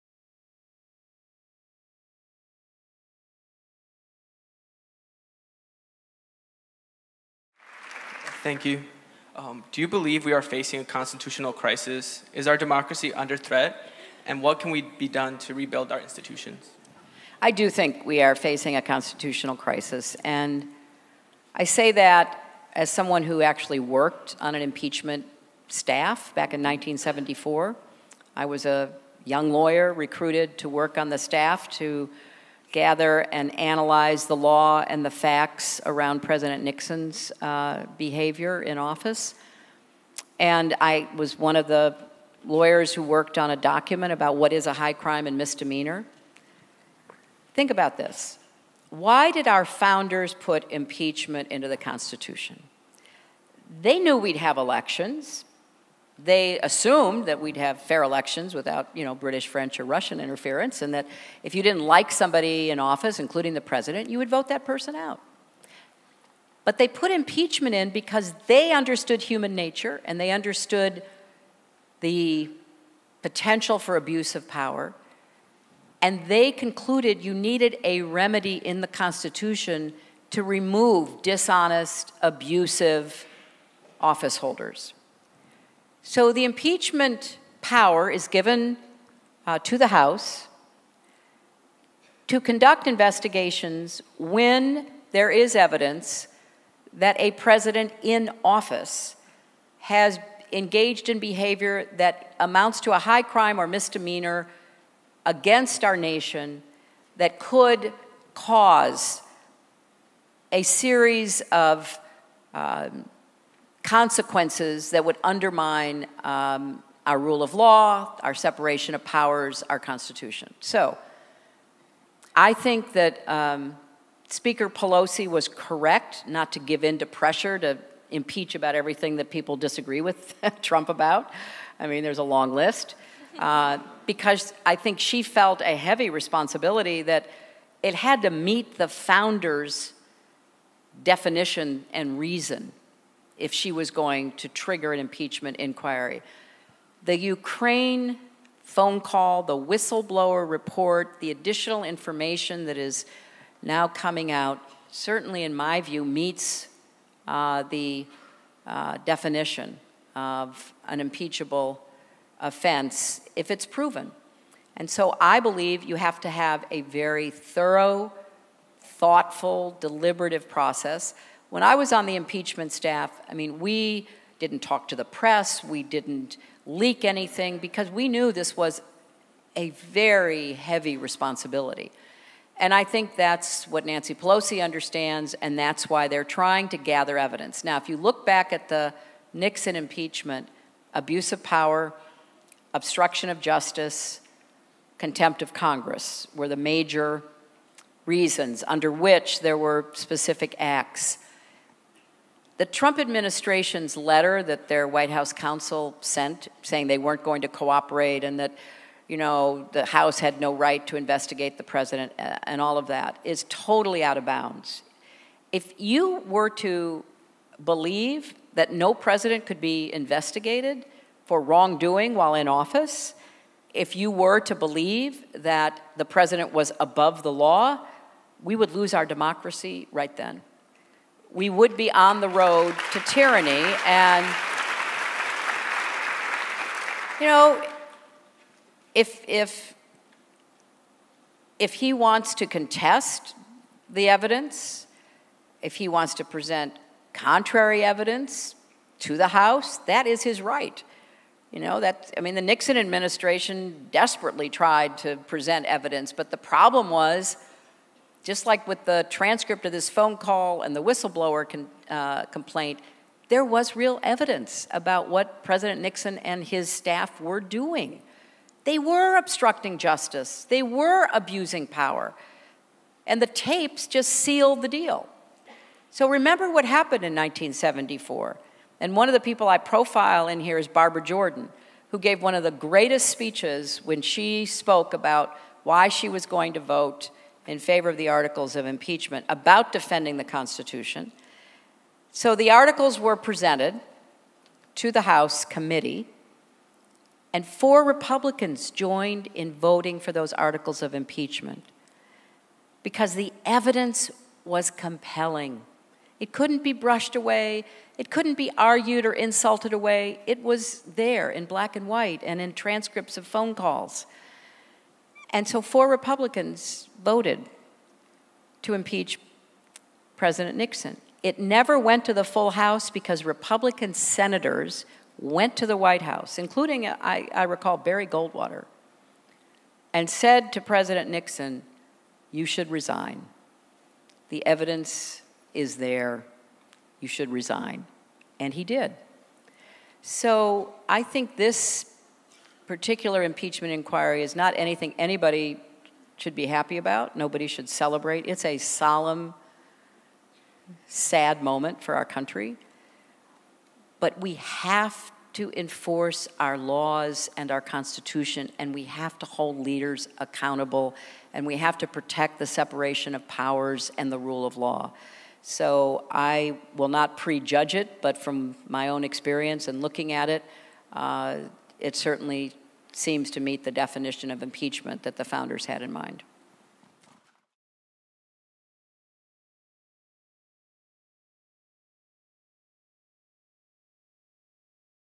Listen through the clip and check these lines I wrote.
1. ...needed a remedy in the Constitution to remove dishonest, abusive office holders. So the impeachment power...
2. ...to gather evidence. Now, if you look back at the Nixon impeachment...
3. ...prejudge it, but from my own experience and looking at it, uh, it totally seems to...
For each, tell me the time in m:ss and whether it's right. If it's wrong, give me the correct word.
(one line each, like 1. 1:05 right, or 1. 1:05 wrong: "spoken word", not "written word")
1. 1:17 right
2. 3:06 right
3. 6:07 wrong: "certainly", not "totally".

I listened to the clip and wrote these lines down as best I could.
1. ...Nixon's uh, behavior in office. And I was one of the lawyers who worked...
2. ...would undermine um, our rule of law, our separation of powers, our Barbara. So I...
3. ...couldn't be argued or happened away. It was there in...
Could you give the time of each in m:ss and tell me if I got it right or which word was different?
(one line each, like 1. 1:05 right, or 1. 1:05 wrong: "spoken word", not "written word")
1. 0:36 right
2. 1:55 wrong: "Constitution", not "Barbara"
3. 5:08 wrong: "insulted", not "happened".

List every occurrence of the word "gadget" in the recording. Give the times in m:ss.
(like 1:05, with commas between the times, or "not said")
not said.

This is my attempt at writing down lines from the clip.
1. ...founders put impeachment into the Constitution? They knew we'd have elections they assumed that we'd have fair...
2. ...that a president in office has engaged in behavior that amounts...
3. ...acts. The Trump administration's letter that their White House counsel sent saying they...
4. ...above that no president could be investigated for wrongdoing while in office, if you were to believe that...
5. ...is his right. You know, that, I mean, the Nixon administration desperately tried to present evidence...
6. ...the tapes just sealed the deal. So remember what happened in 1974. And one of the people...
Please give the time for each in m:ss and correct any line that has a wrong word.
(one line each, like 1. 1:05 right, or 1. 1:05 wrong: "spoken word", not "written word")
1. 0:49 right
2. 1:36 right
3. 3:20 right
4. 3:37 wrong: "believe", not "above"
5. 4:10 right
6. 4:33 right.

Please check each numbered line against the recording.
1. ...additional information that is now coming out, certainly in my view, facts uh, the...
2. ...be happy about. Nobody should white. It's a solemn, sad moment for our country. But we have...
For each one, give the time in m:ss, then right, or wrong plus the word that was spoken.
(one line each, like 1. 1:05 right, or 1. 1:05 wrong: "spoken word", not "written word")
1. 2:31 wrong: "meets", not "facts"
2. 5:46 wrong: "celebrate", not "white".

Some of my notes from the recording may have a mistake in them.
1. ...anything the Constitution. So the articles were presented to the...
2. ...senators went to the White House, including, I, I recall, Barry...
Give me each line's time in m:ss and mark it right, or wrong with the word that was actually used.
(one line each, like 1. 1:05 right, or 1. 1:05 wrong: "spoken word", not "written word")
1. 4:49 wrong: "defending", not "anything"
2. 5:23 right.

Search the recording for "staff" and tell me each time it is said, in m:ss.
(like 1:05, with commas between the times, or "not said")
0:25, 0:31, 2:52, 4:26.